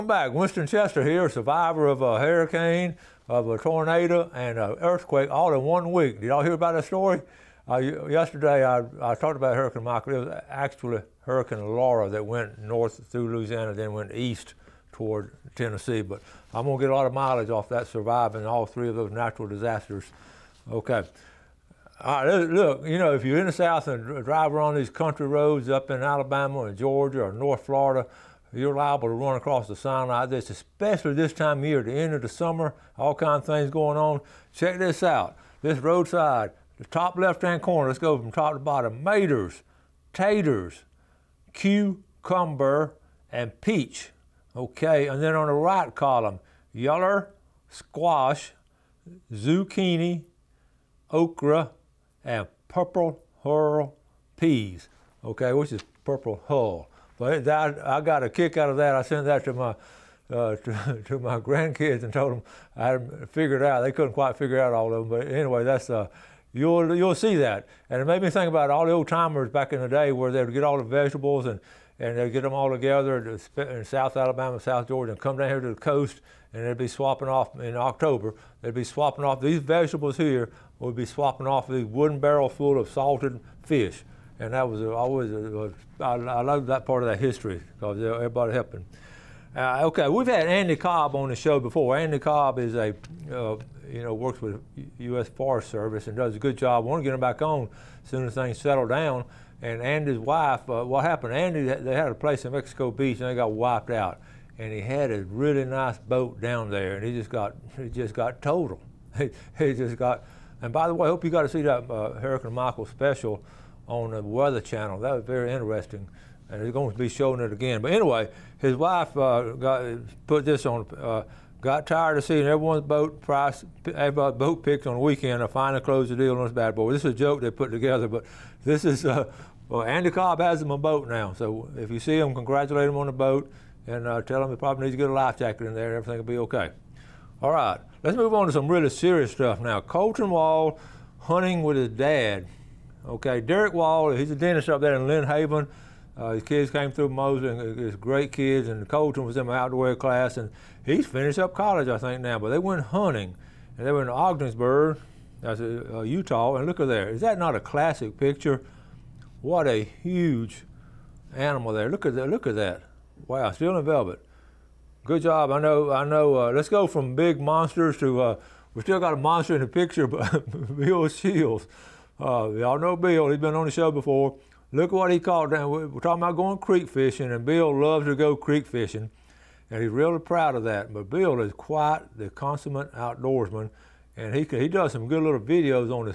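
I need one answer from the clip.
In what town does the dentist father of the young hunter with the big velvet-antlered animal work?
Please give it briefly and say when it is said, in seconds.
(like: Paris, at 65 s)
Lynn Haven, at 145 s.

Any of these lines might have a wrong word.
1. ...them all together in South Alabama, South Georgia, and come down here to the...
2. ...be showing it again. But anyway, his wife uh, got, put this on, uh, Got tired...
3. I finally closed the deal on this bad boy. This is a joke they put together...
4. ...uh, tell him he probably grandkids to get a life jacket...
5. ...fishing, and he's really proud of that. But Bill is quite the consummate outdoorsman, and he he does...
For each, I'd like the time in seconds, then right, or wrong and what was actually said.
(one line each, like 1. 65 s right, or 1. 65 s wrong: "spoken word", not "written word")
1. 72 s right
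2. 116 s right
3. 125 s right
4. 134 s wrong: "needs", not "grandkids"
5. 178 s right.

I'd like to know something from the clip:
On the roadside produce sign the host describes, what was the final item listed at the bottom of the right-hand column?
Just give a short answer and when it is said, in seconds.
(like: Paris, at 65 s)
purple hull peas, at 52 s.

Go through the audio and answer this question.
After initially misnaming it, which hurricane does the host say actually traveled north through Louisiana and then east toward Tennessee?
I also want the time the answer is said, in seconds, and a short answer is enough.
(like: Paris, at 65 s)
Hurricane Laura, at 11 s.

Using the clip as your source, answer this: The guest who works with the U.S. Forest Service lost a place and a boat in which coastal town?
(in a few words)
Mexico Beach.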